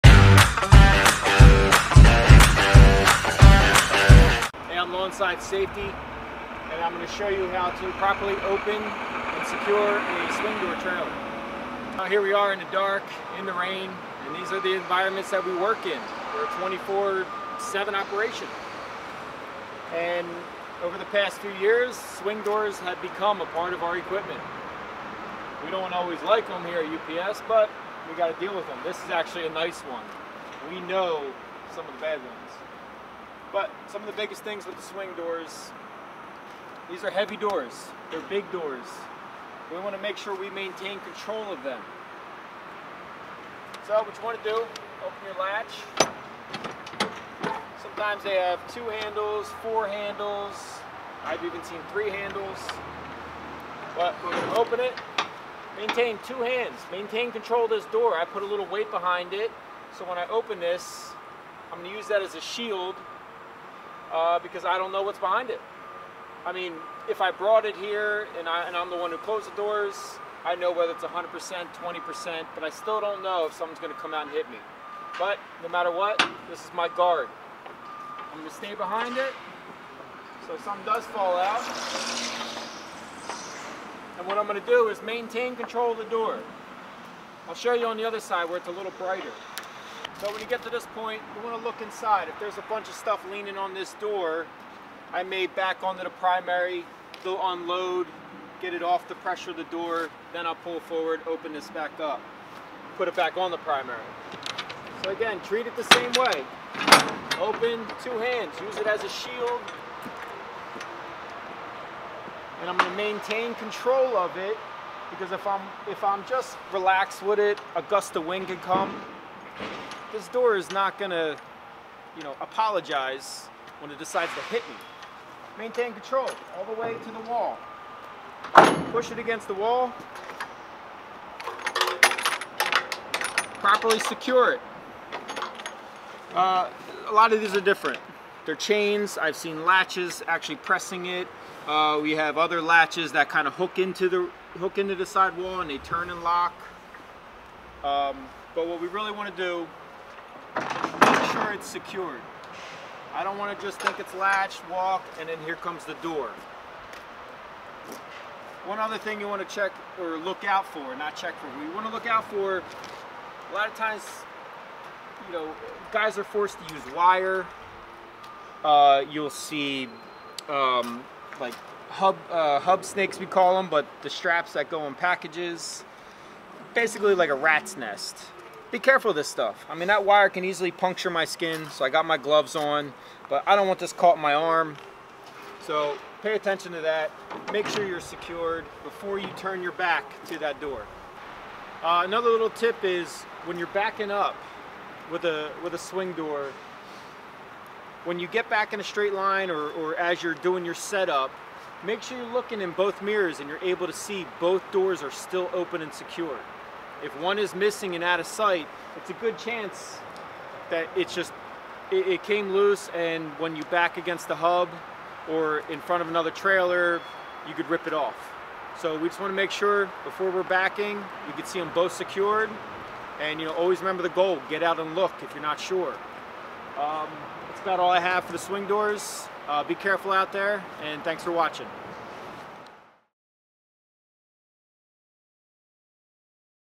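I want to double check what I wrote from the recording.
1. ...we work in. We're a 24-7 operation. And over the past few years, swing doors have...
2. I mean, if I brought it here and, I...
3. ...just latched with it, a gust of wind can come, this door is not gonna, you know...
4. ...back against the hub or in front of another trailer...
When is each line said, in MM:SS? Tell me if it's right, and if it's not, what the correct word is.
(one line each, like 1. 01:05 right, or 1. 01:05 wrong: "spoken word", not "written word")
1. 00:15 right
2. 01:06 right
3. 01:56 wrong: "relaxed", not "latched"
4. 03:33 right.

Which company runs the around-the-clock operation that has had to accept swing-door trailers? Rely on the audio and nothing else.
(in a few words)
UPS.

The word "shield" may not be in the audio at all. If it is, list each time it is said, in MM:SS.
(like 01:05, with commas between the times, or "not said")
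01:02, 01:49.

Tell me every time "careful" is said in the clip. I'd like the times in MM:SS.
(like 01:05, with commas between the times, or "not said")
02:58, 03:49.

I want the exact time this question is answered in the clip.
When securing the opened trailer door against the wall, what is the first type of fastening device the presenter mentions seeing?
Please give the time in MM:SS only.
02:18.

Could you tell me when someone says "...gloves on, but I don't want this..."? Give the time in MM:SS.
03:02.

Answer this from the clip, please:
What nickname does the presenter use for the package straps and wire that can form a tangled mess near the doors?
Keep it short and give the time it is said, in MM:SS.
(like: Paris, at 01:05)
Hub snakes, at 02:52.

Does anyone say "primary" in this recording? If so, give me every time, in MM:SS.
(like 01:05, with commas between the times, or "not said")
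01:36, 01:43.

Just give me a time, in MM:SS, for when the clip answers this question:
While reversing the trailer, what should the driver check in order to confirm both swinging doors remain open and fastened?
03:22.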